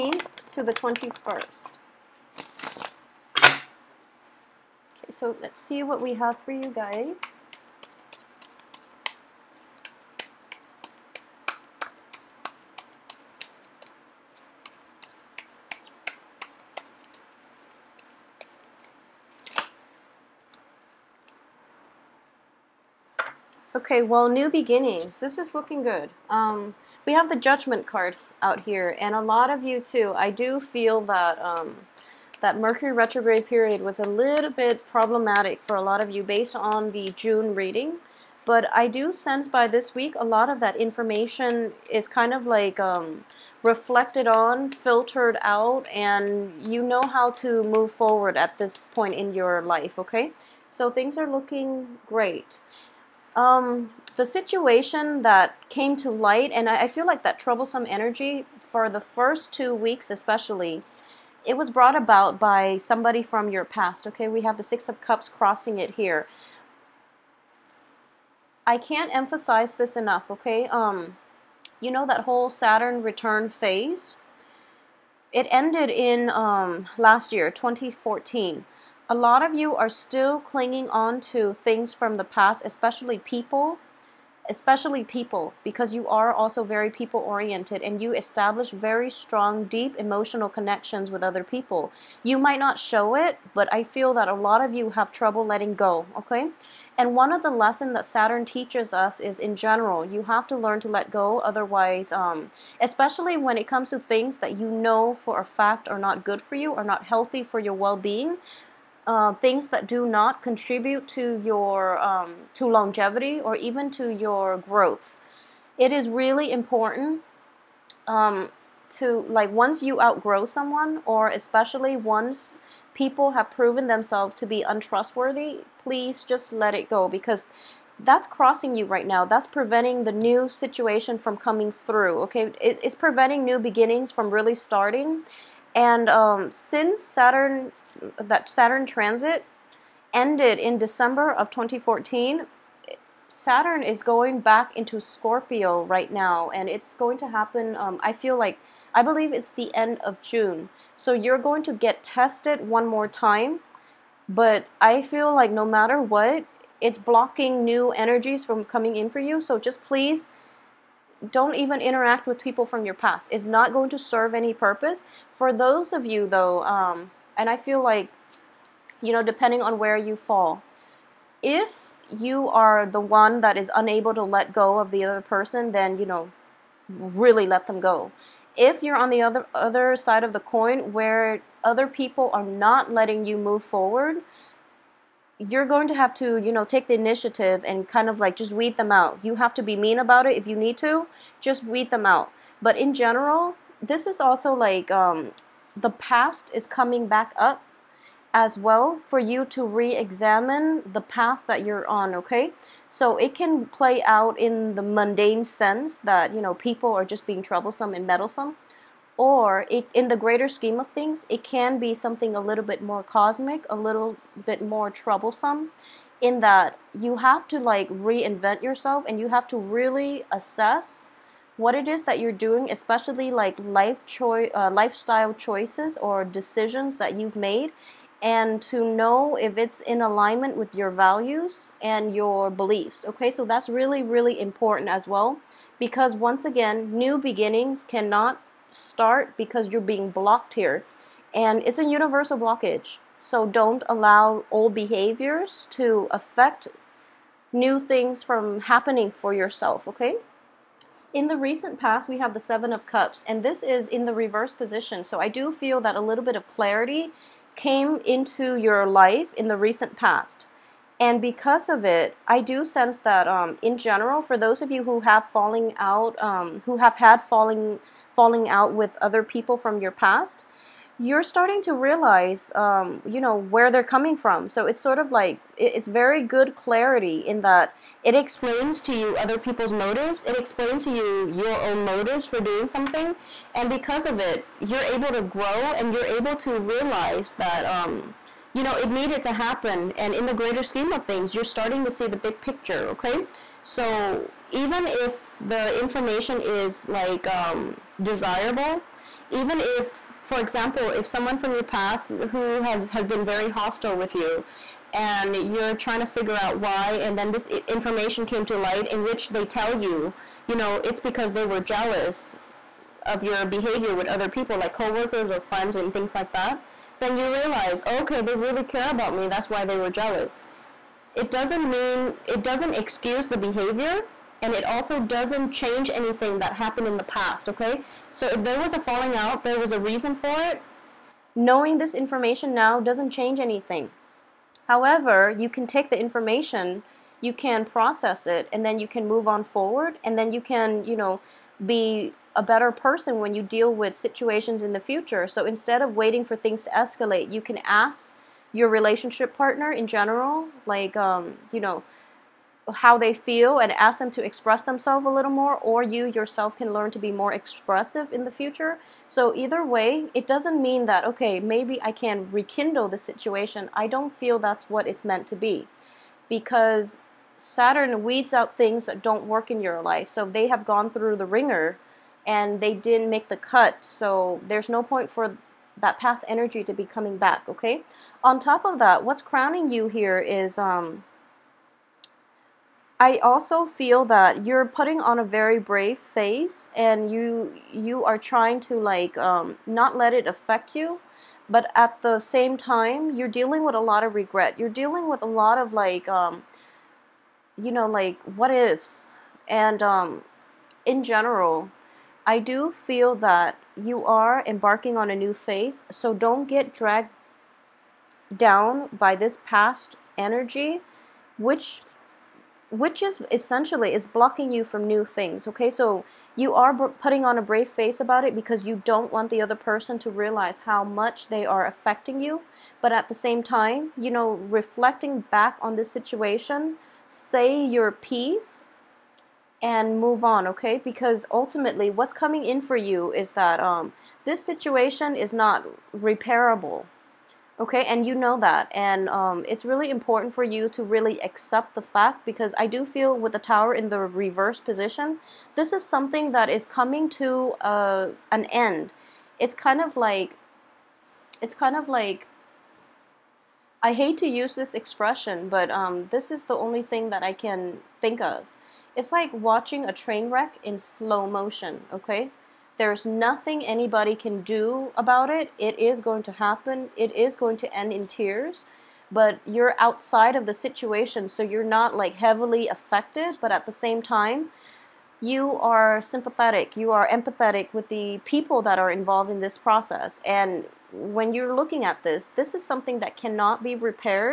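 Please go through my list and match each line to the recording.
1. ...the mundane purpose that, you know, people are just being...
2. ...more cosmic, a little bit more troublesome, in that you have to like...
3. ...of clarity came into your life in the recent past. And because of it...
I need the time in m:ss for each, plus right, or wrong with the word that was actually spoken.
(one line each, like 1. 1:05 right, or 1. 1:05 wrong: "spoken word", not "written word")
1. 3:24 wrong: "sense", not "purpose"
2. 3:32 right
3. 4:16 right.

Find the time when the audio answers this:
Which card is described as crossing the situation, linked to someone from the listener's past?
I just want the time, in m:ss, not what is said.
1:04.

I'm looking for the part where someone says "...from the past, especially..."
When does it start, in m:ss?
1:21.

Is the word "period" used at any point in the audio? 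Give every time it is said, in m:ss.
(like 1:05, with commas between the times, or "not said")
0:33.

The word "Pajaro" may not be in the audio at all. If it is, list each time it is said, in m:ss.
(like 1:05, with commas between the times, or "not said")
not said.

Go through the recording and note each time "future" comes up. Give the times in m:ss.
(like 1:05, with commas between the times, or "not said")
5:44, 5:58.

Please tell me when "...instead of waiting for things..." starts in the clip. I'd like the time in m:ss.
5:45.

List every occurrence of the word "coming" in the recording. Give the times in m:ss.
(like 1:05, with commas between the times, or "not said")
2:11, 2:38, 3:16, 4:33, 6:16, 7:12, 7:26.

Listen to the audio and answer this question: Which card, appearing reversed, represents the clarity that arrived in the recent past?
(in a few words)
Seven of Cups.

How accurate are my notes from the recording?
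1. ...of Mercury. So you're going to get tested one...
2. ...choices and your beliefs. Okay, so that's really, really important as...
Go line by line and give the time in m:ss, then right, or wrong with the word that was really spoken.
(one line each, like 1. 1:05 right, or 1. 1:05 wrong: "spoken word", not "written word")
1. 2:29 wrong: "June", not "Mercury"
2. 3:50 wrong: "values", not "choices".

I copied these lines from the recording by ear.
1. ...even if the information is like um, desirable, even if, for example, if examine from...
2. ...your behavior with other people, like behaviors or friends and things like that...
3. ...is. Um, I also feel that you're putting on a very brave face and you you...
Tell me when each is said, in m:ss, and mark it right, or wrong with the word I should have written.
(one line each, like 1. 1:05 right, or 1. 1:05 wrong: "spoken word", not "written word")
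1. 4:54 wrong: "someone", not "examine"
2. 5:13 wrong: "coworkers", not "behaviors"
3. 6:20 right.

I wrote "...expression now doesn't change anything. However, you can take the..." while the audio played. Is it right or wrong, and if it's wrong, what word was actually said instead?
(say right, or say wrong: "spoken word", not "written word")
wrong: "information", not "expression".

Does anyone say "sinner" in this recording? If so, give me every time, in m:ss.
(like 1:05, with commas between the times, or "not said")
not said.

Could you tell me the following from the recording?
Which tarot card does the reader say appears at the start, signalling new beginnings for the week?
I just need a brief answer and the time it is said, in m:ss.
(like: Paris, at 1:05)
Judgment, at 0:27.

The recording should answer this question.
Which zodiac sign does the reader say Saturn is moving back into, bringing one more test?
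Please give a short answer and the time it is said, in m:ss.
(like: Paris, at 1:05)
Scorpio, at 2:24.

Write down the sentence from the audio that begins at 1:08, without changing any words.
I can't emphasize this enough, okay?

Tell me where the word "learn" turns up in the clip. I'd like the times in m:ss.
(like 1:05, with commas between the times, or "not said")
1:40, 5:56.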